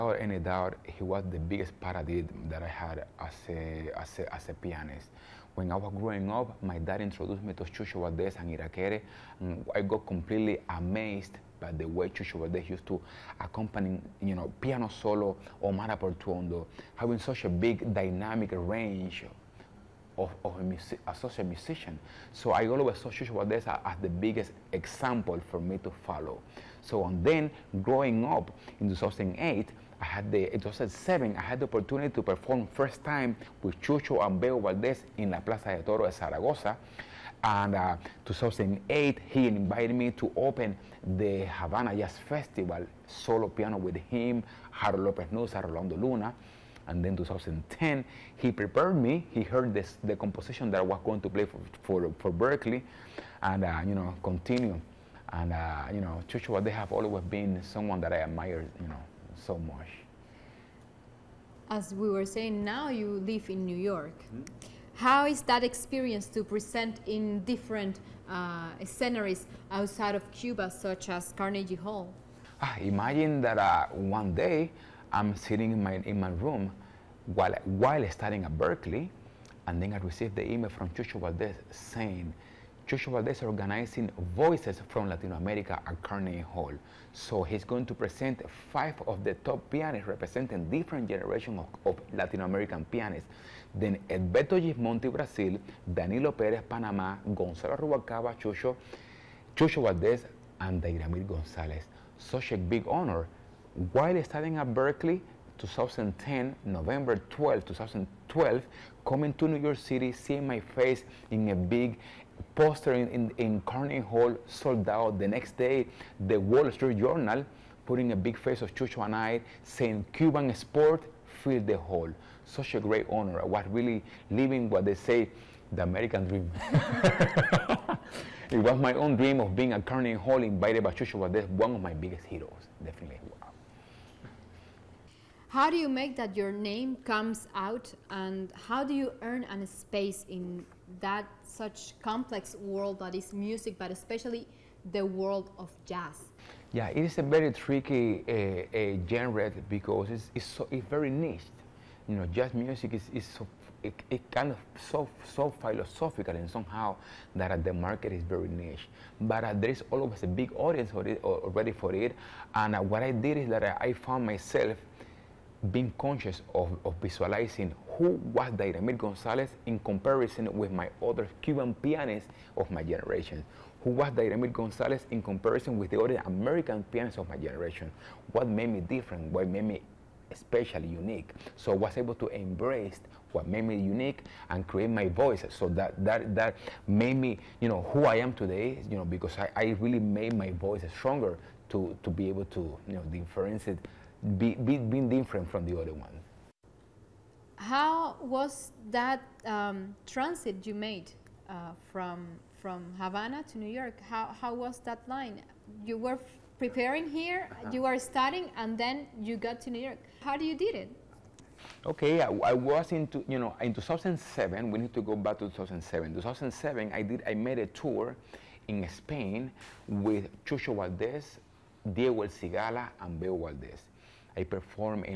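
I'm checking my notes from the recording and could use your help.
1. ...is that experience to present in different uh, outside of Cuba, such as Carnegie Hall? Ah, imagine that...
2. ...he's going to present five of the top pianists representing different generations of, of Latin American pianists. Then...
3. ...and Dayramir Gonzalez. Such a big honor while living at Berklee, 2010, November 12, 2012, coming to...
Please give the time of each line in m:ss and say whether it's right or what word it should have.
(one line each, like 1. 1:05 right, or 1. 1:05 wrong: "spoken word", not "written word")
1. 1:05 right
2. 1:27 right
3. 1:40 wrong: "studying", not "living".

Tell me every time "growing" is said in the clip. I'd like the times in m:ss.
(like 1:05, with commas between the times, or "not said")
0:05, 0:27.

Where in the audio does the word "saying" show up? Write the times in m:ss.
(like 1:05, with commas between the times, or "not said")
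1:02, 1:21, 1:59.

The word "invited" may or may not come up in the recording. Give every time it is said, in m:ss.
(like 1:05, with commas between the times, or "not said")
0:39, 2:10.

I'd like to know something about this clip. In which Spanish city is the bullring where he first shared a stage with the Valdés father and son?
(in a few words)
Zaragoza.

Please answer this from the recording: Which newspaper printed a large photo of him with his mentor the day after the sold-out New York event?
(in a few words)
The Wall Street Journal.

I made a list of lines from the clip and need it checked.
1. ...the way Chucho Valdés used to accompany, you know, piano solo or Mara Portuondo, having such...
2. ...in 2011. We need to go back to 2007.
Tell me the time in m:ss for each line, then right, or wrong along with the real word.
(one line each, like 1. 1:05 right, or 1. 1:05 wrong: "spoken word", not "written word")
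1. 0:11 right
2. 3:33 wrong: "2007", not "2011".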